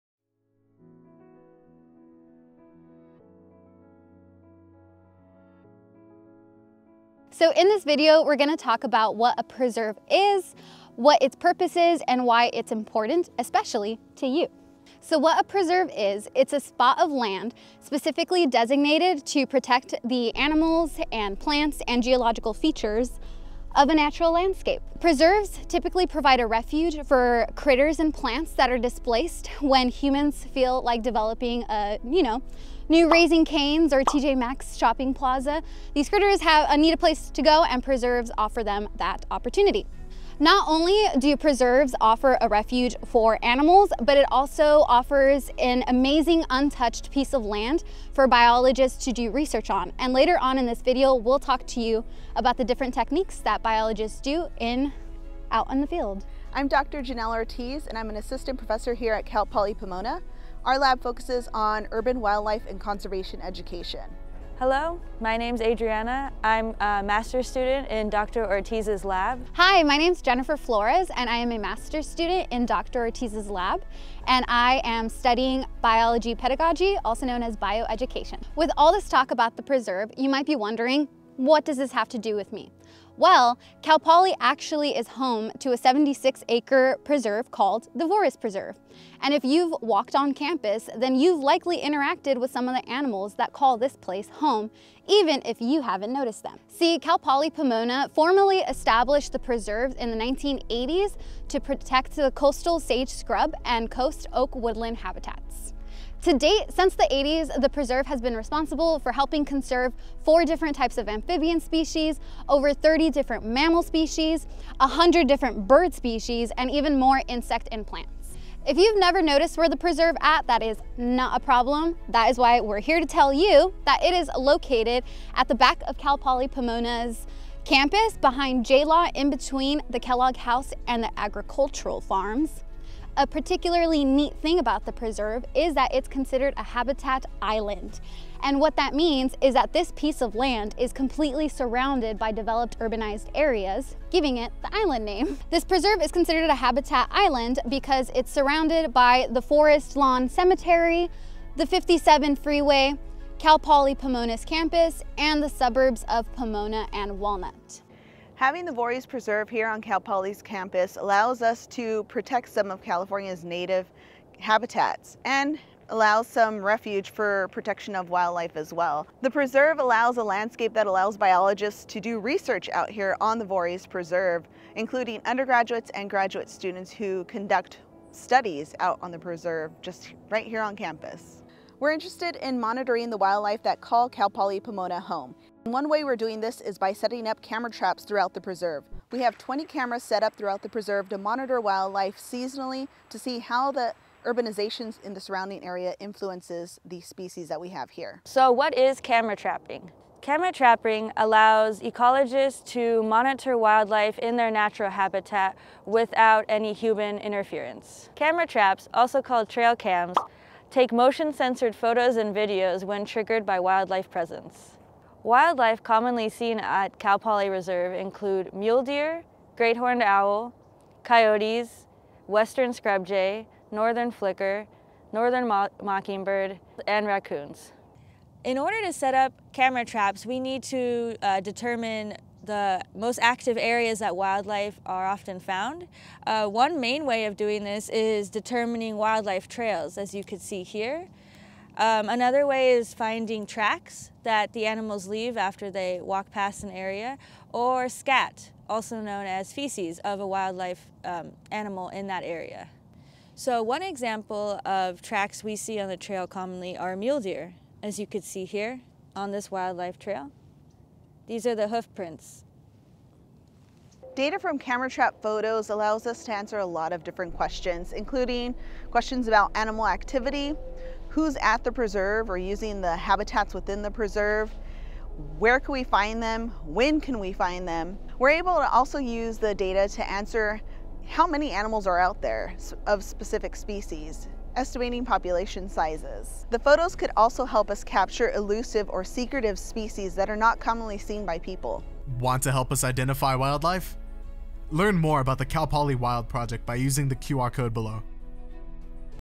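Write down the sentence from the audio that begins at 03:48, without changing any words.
In order to set up camera traps, we need to uh, determine the most active areas that wildlife are often found.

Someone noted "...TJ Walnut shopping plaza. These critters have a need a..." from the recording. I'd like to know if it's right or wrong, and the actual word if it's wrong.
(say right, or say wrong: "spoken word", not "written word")
wrong: "Maxx", not "Walnut".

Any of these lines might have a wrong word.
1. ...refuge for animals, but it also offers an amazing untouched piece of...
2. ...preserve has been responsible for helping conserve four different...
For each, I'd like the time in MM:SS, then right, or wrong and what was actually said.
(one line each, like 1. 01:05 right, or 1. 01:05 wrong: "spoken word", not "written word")
1. 00:42 right
2. 01:47 right.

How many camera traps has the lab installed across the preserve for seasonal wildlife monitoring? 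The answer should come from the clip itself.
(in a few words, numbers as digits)
20.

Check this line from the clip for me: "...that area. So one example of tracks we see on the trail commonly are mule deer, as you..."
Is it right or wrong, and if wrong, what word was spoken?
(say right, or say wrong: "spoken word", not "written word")
right.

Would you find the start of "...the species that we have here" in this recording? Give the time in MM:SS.
03:16.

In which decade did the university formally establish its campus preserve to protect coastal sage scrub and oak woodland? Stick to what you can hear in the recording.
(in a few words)
1980s.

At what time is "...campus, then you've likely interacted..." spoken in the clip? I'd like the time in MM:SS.
01:30.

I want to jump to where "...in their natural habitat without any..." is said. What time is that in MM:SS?
03:24.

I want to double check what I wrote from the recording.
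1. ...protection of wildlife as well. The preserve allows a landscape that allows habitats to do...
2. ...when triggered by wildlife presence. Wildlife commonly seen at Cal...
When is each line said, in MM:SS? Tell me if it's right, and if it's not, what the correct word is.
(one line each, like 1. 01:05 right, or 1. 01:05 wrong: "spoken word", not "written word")
1. 02:47 wrong: "biologists", not "habitats"
2. 03:32 right.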